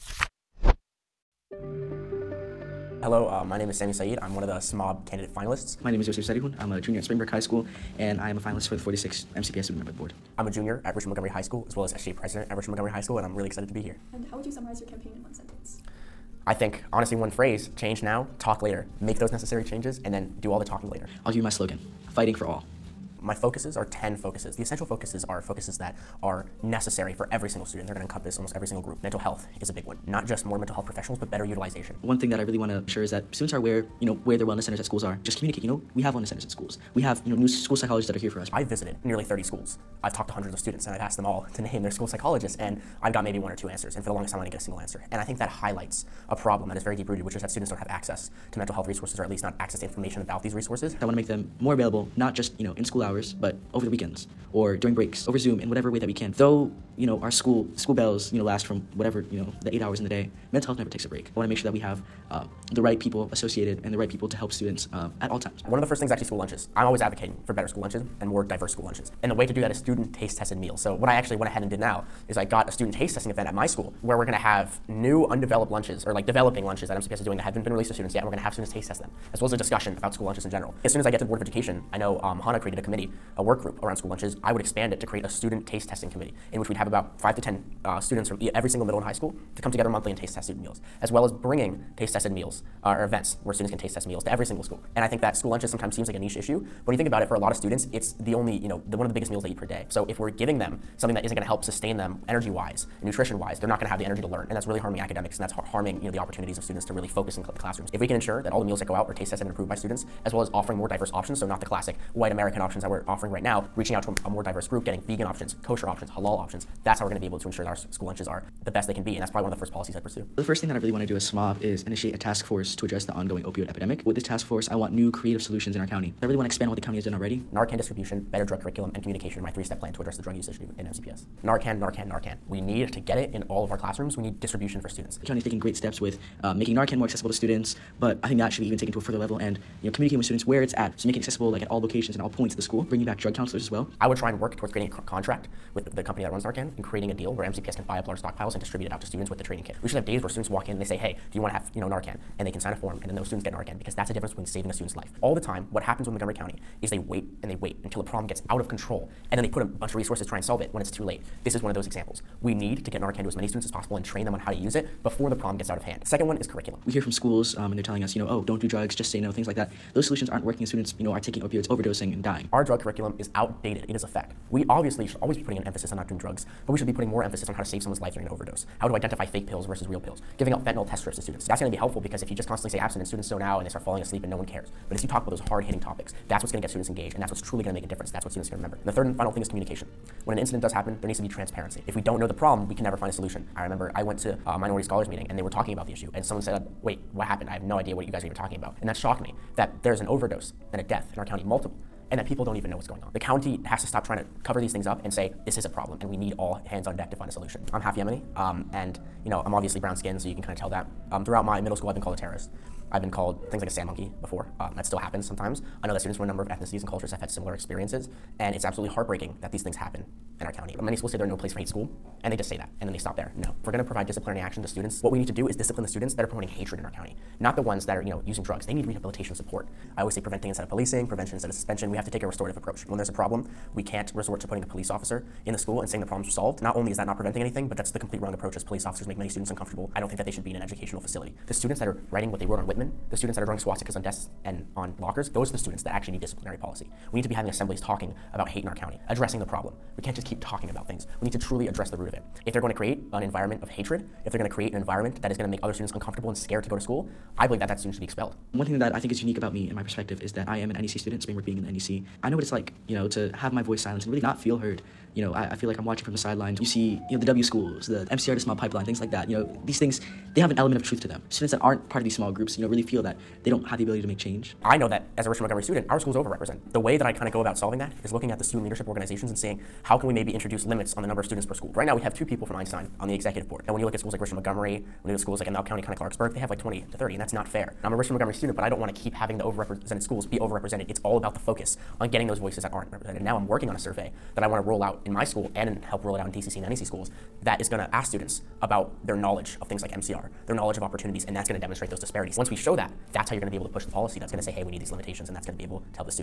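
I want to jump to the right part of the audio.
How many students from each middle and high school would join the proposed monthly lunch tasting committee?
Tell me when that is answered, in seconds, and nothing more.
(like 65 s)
87 s.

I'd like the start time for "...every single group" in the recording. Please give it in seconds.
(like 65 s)
28 s.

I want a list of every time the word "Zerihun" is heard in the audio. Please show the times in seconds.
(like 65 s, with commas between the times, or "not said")
6 s.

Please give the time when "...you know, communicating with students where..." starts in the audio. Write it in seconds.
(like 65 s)
139 s.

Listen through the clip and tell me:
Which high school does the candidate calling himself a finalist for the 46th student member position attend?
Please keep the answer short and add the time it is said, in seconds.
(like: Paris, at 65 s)
Springbrook High School, at 7 s.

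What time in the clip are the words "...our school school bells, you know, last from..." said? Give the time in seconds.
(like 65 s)
57 s.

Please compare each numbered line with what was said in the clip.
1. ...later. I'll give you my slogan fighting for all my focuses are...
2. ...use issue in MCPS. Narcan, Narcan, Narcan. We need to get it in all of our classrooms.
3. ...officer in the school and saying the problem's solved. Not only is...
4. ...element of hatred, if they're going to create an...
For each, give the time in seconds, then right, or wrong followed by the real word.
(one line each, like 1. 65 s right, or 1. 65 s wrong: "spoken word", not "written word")
1. 20 s right
2. 130 s right
3. 234 s right
4. 253 s wrong: "environment", not "element".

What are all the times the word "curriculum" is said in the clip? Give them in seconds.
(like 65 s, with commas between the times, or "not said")
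128 s, 166 s, 172 s.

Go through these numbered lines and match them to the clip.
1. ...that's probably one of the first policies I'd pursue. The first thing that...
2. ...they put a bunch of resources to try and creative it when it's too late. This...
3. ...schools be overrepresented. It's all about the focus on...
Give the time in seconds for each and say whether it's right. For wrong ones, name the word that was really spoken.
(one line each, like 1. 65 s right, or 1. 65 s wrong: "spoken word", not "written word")
1. 119 s right
2. 159 s wrong: "solve", not "creative"
3. 290 s right.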